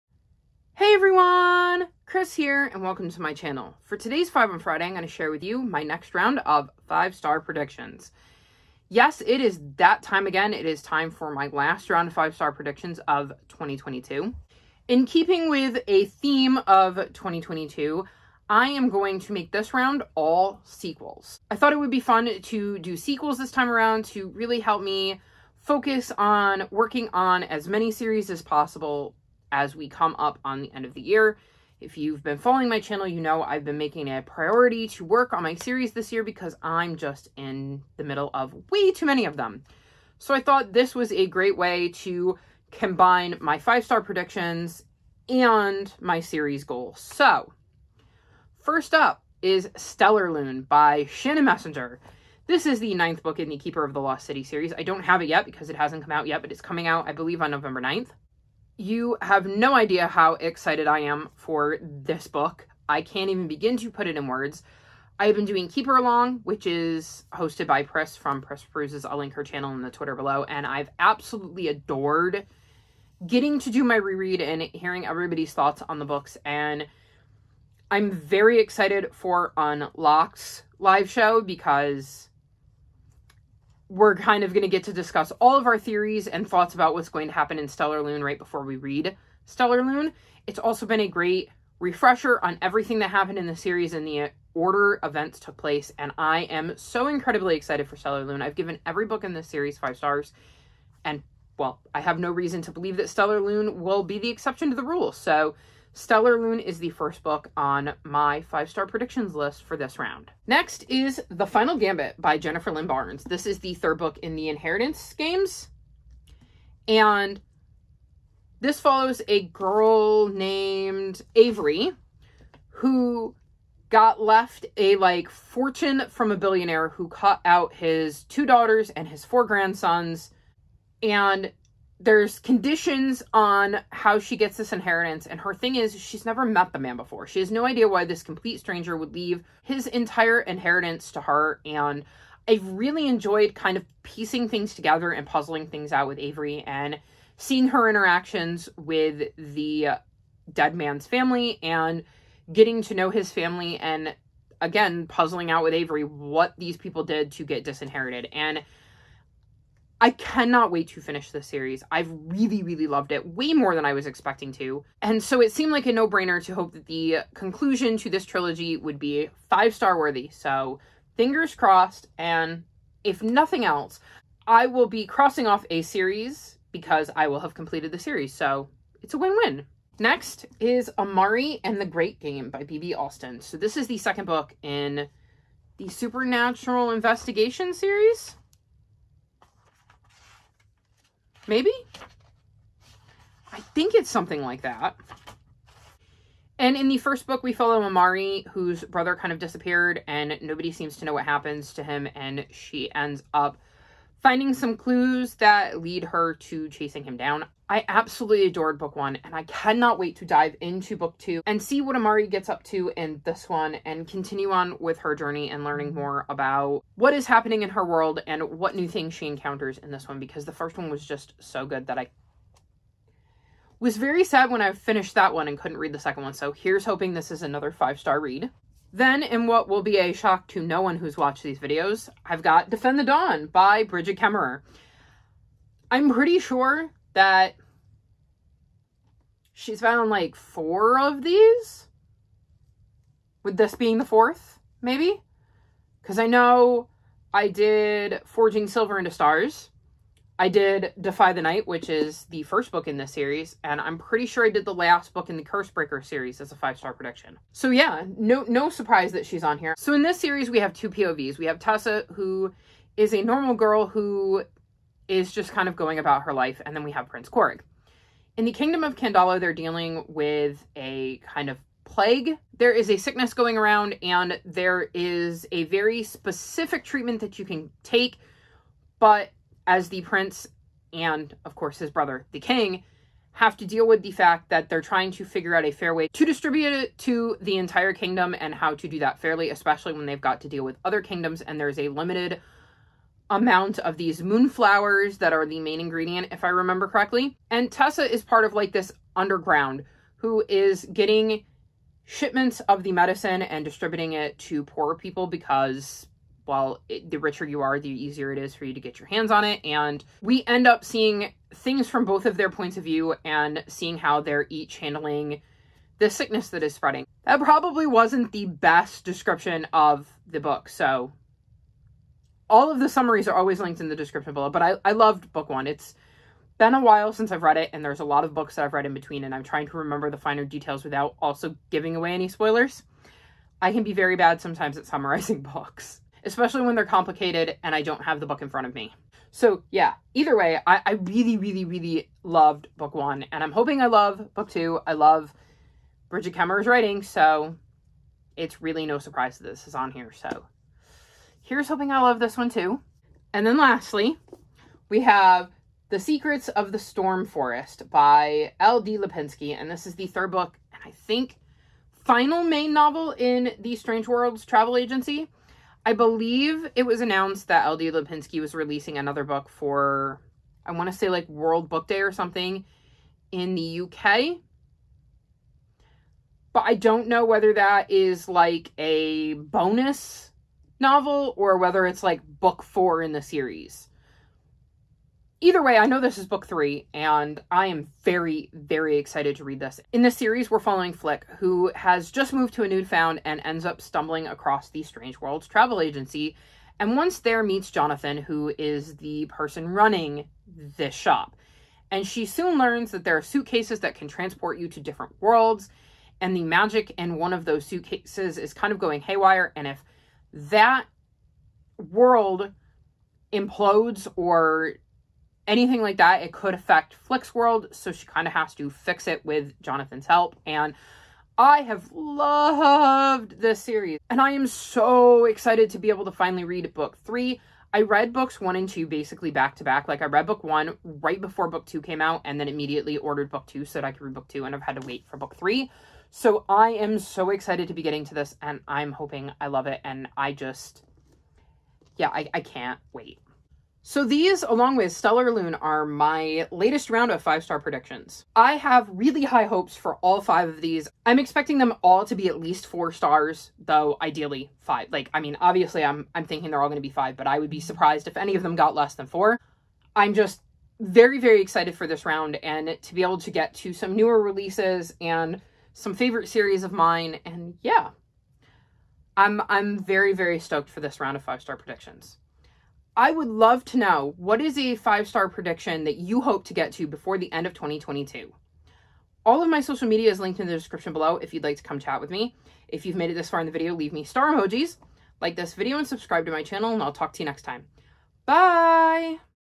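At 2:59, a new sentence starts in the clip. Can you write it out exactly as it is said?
Next is Amari and the Great Game by B.B.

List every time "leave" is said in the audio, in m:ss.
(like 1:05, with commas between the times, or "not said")
2:19, 8:03.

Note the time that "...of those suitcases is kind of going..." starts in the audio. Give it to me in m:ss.
6:47.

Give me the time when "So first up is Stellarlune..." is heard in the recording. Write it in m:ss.
0:46.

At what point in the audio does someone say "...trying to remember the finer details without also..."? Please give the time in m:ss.
5:29.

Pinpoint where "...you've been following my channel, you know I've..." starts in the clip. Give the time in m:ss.
0:31.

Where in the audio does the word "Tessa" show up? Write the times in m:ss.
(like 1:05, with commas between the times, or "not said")
4:21, 4:57.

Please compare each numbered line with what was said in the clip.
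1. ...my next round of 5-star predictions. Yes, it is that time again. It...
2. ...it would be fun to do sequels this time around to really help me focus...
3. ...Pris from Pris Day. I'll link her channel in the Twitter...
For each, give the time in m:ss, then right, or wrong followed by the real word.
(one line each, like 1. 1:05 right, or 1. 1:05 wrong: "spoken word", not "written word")
1. 0:05 right
2. 0:21 right
3. 1:07 wrong: "Peruses", not "Day".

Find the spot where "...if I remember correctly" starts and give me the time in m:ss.
4:56.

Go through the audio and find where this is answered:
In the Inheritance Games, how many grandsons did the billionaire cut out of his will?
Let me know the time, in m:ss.
2:09.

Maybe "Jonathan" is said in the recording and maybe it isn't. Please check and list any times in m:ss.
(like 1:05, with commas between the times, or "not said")
6:37, 6:59.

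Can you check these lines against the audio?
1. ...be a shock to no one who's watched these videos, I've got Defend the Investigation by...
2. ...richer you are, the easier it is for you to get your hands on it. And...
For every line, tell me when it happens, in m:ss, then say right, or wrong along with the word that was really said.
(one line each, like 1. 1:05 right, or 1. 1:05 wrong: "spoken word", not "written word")
1. 3:49 wrong: "Dawn", not "Investigation"
2. 5:07 right.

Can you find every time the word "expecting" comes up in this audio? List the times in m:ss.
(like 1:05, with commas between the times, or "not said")
2:44, 7:31.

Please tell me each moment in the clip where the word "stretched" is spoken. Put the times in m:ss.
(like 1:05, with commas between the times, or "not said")
not said.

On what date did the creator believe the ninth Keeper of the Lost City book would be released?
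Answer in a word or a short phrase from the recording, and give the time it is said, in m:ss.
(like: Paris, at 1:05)
November 9th, at 0:57.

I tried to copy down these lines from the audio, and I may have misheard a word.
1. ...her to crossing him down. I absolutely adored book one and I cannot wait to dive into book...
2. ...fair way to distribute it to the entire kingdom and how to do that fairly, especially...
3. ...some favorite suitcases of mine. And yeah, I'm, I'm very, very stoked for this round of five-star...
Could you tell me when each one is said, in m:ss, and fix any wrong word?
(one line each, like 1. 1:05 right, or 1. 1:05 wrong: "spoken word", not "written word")
1. 3:26 wrong: "chasing", not "crossing"
2. 4:45 right
3. 7:45 wrong: "series", not "suitcases".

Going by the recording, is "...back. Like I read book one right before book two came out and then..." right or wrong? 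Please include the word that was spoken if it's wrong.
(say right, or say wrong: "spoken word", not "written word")
right.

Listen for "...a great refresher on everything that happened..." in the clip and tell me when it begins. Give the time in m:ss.
1:31.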